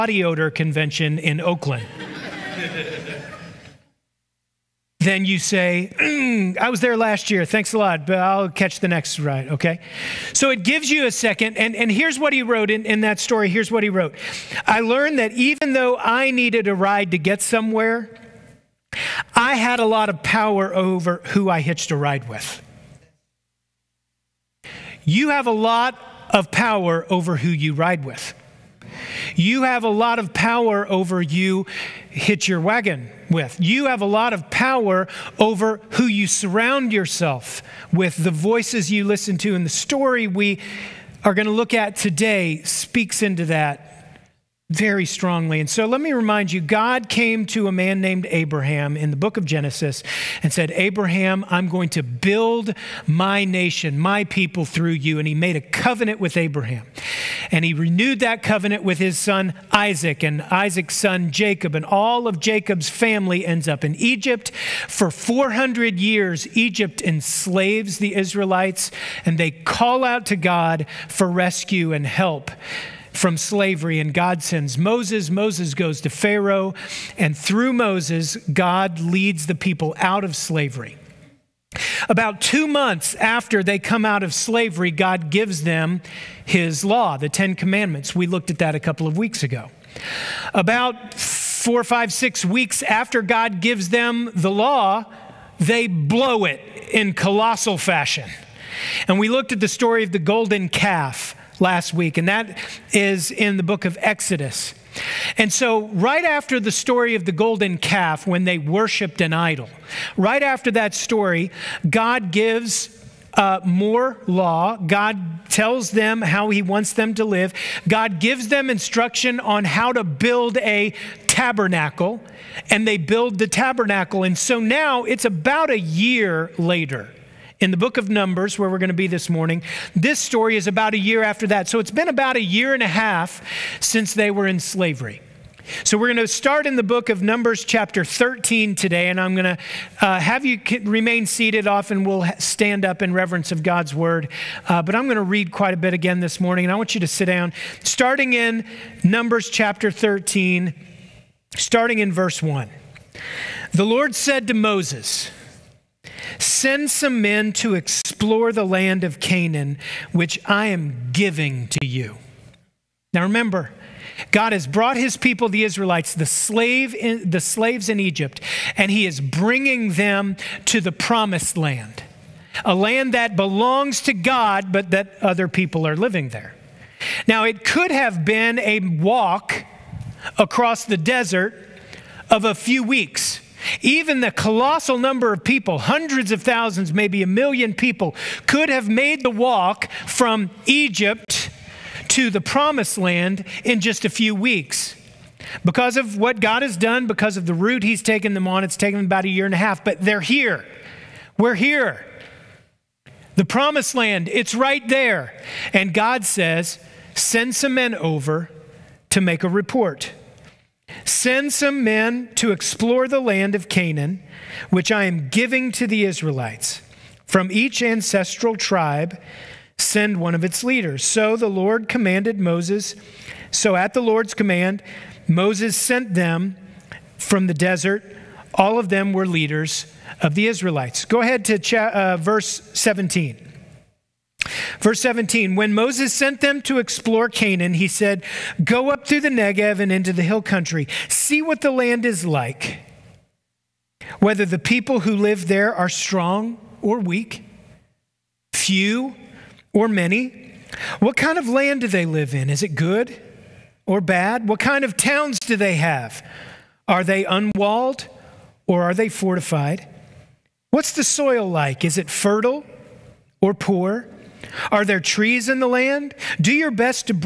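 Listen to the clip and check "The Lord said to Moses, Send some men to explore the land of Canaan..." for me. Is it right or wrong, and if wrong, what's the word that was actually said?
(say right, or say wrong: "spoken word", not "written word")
right.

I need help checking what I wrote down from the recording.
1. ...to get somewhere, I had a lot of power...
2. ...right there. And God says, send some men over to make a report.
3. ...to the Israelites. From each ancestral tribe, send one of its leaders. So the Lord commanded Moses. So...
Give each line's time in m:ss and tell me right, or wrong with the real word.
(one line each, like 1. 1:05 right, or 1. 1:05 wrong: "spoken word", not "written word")
1. 0:17 right
2. 3:24 right
3. 3:35 right.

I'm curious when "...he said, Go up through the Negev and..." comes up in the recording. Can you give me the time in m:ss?
3:57.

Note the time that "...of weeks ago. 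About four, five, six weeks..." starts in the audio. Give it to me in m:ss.
1:29.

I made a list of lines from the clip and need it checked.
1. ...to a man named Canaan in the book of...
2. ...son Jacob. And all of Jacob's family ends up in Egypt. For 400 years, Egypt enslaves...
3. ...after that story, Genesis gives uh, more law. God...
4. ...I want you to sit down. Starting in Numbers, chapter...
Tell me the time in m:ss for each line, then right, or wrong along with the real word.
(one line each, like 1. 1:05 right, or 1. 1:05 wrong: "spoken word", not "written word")
1. 0:47 wrong: "Abraham", not "Canaan"
2. 1:00 right
3. 1:50 wrong: "God", not "Genesis"
4. 2:26 right.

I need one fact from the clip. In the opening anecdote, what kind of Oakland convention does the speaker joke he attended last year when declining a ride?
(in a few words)
odor convention.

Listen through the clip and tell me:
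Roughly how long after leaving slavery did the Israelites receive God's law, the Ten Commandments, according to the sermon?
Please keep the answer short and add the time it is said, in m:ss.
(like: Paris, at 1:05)
about two months, at 1:22.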